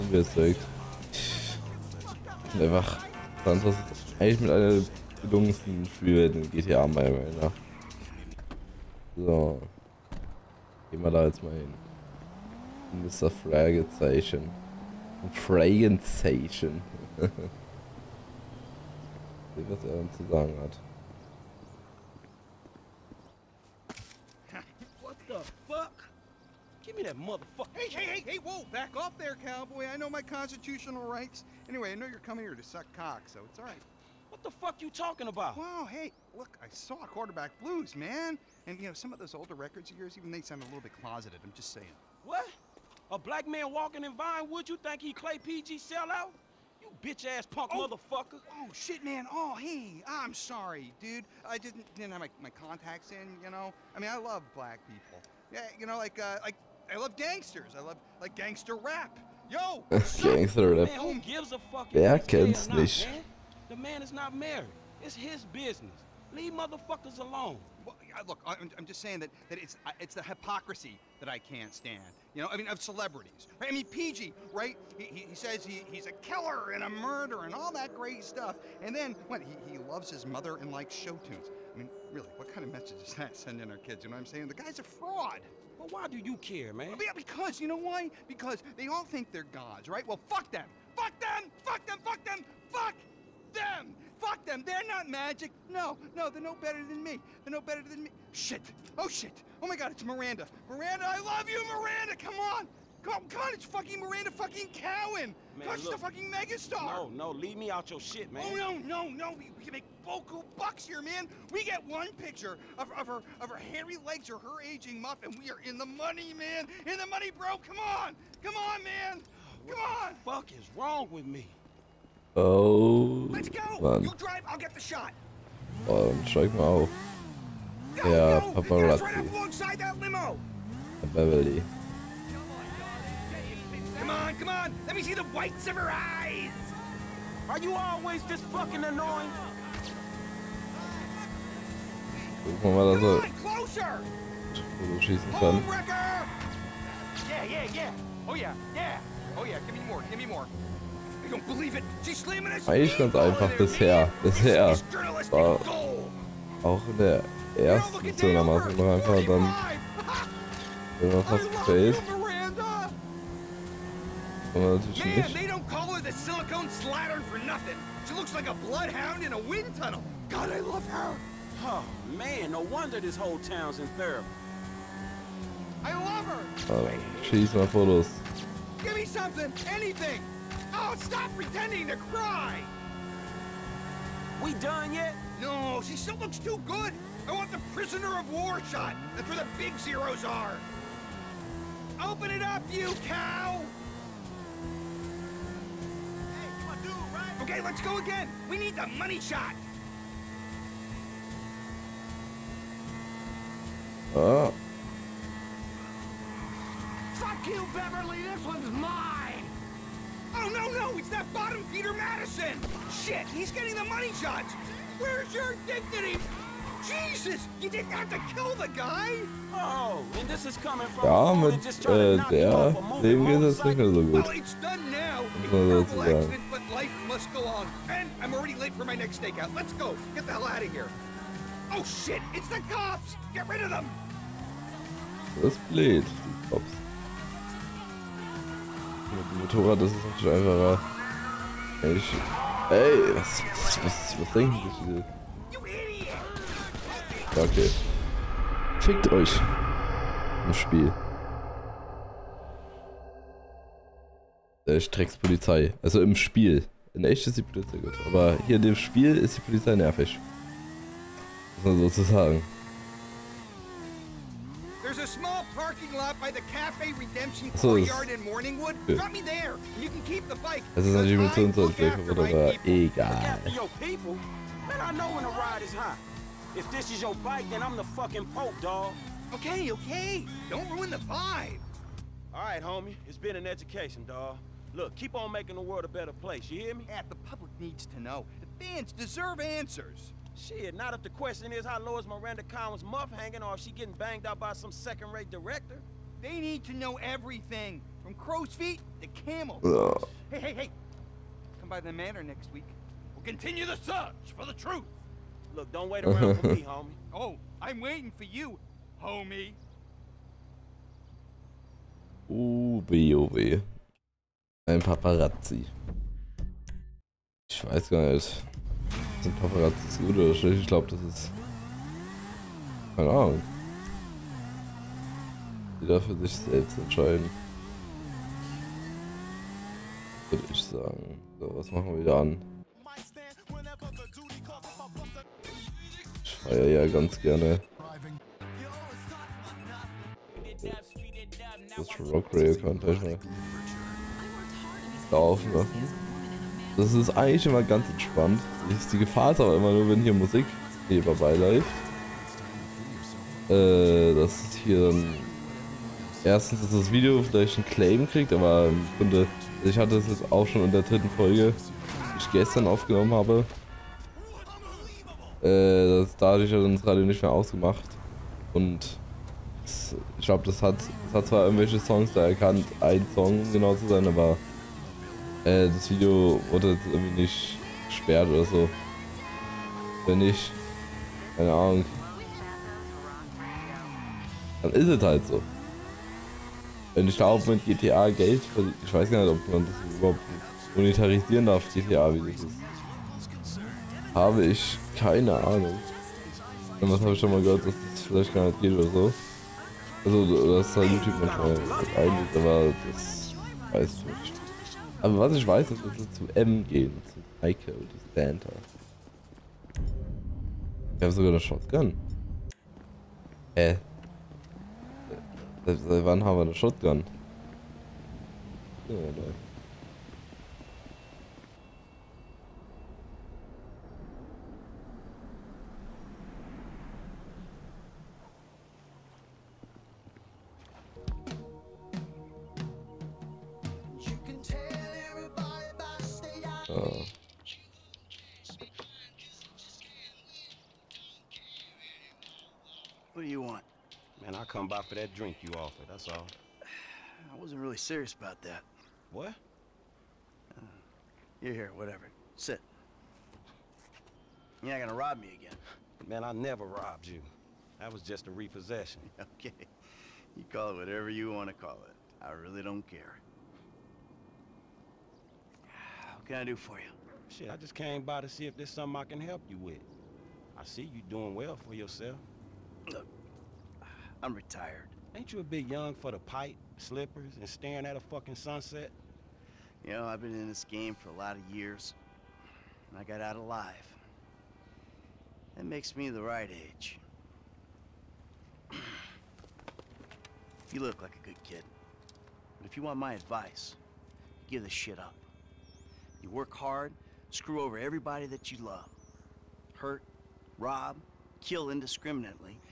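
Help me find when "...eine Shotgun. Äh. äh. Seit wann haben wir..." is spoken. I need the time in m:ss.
6:51.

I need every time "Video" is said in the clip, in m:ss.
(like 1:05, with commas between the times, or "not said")
5:56, 6:15.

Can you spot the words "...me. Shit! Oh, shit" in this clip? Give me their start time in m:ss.
1:38.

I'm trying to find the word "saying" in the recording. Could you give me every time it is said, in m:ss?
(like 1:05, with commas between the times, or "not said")
0:41, 1:08, 1:24.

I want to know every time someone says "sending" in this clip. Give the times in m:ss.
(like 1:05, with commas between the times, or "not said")
1:23.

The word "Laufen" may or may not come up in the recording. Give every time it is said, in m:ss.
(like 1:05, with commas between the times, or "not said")
5:45.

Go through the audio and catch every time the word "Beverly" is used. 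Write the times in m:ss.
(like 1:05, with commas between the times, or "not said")
2:11, 3:27.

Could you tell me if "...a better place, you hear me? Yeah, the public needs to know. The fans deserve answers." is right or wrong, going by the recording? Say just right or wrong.
right.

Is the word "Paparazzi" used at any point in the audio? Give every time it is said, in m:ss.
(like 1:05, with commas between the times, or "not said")
2:08, 5:14, 5:19.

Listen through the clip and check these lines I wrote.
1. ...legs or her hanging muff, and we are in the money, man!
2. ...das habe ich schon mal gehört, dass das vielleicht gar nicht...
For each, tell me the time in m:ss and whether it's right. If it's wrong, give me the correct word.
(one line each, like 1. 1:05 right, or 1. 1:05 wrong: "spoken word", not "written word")
1. 1:54 wrong: "aging", not "hanging"
2. 6:36 right.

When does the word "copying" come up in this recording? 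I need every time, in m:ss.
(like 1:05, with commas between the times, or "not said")
not said.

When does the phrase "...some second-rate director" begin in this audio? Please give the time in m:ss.
4:54.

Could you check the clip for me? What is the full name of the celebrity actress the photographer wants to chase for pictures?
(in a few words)
Miranda Cowan.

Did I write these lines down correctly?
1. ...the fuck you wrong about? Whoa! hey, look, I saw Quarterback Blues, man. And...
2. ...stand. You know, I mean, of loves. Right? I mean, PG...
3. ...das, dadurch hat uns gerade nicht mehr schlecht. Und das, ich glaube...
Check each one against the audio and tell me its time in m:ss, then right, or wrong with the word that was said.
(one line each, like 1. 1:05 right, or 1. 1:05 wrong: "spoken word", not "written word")
1. 0:34 wrong: "talking", not "wrong"
2. 1:11 wrong: "celebrities", not "loves"
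3. 6:05 wrong: "ausgemacht", not "schlecht".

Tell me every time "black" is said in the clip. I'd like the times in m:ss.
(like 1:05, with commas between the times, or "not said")
0:43, 0:54.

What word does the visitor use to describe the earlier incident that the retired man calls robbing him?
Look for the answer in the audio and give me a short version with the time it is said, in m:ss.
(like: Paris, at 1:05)
repossession, at 7:38.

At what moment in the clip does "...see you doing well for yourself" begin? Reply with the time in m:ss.
7:50.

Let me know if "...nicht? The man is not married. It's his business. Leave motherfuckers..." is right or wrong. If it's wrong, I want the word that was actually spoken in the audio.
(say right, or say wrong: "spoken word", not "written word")
right.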